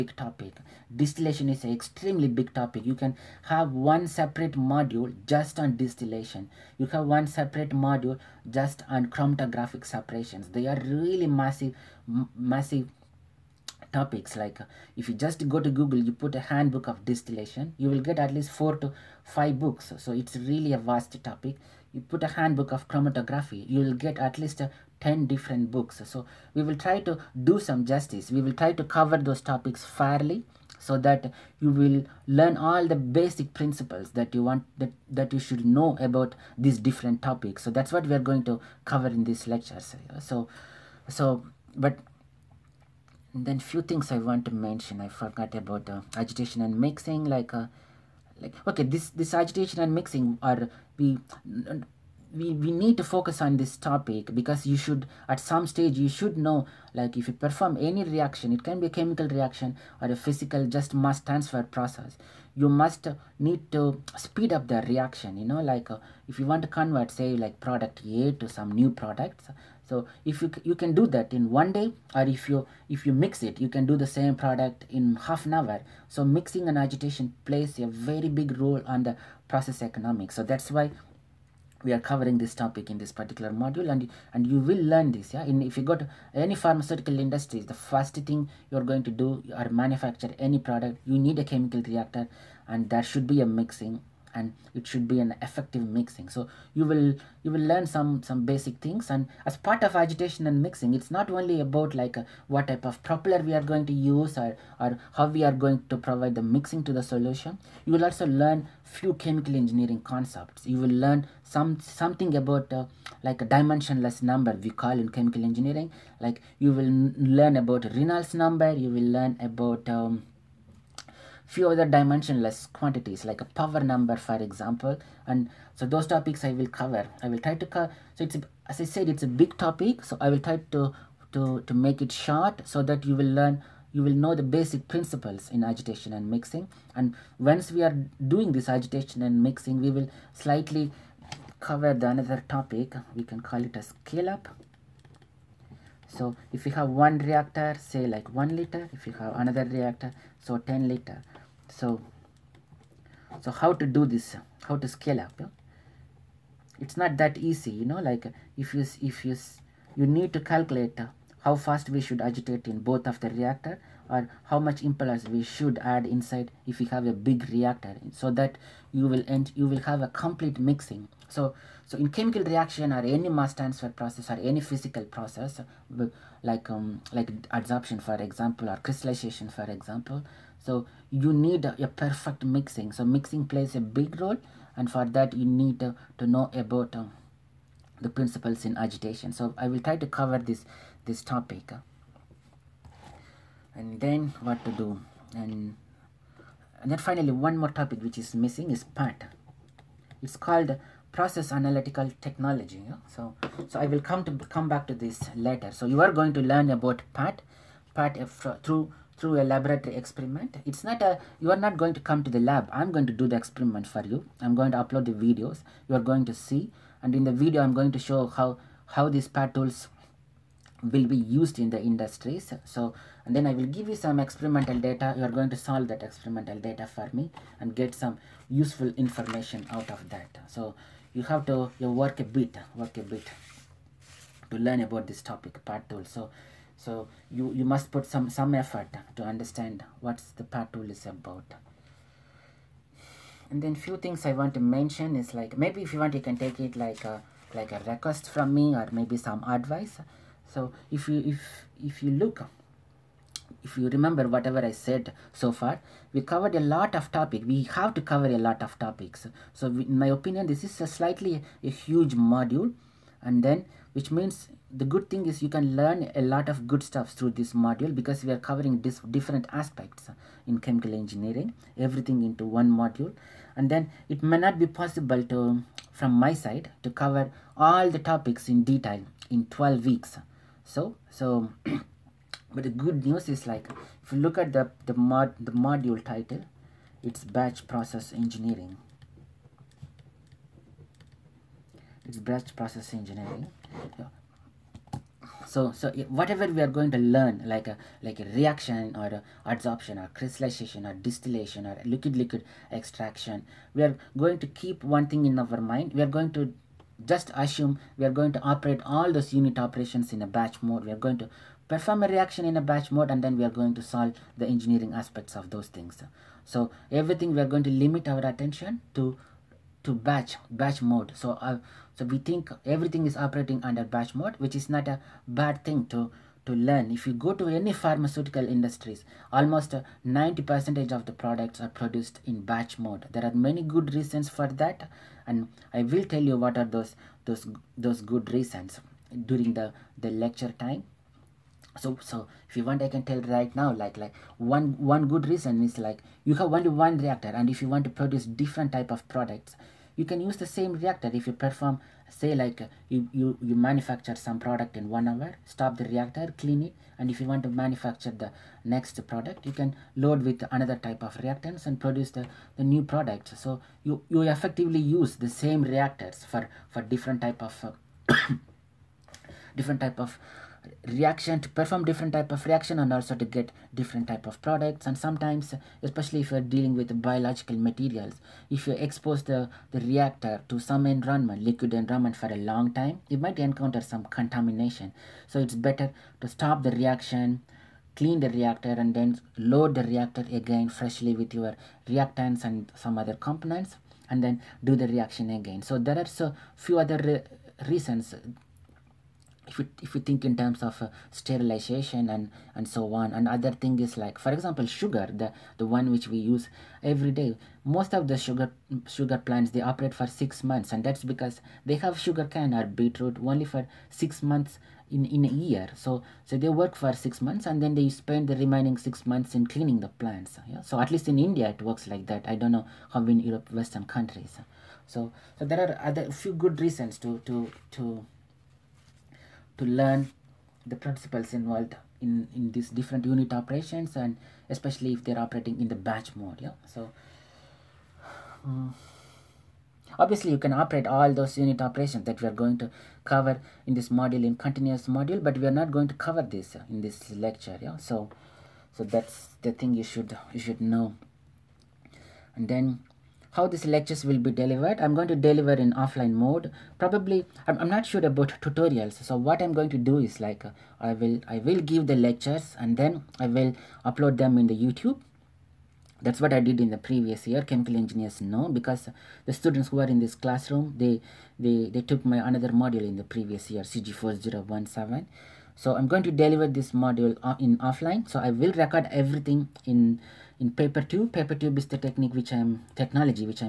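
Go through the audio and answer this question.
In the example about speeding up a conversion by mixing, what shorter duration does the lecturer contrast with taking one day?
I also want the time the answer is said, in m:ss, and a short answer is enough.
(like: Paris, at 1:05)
half an hour, at 1:15.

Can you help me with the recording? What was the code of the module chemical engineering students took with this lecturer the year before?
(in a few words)
CG4017.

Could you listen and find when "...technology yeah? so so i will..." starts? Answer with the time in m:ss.
3:22.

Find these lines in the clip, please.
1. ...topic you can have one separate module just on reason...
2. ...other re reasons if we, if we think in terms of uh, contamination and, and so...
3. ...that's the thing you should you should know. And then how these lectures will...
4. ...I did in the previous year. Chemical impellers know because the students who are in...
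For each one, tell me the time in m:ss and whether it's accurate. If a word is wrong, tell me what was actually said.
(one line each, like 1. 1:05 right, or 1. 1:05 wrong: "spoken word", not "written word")
1. 0:02 wrong: "distillation", not "reason"
2. 6:36 wrong: "sterilization", not "contamination"
3. 7:28 right
4. 7:46 wrong: "engineers", not "impellers".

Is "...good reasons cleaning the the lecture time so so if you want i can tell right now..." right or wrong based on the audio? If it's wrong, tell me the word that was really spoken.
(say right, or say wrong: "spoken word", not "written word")
wrong: "during", not "cleaning".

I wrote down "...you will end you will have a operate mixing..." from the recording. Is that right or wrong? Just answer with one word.
wrong.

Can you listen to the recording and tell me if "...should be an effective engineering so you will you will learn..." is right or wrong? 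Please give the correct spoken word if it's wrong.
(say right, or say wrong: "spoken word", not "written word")
wrong: "mixing", not "engineering".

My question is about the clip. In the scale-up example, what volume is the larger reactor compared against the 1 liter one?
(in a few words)
10 liter.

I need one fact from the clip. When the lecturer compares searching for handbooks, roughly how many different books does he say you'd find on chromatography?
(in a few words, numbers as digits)
10.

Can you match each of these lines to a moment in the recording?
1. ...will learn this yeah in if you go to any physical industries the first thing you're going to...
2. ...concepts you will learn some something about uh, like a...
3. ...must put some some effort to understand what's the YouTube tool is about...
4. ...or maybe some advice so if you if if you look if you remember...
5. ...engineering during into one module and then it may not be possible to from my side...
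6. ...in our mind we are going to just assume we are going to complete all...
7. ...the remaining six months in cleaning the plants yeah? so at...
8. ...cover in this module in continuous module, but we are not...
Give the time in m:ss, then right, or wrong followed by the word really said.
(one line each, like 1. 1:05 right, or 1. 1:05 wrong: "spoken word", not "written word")
1. 1:24 wrong: "pharmaceutical", not "physical"
2. 1:50 right
3. 3:57 wrong: "PAT", not "YouTube"
4. 4:08 right
5. 4:30 wrong: "everything", not "during"
6. 5:05 wrong: "operate", not "complete"
7. 6:58 right
8. 7:23 right.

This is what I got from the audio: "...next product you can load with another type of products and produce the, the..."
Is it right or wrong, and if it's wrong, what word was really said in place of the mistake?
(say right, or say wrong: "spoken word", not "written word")
wrong: "reactants", not "products".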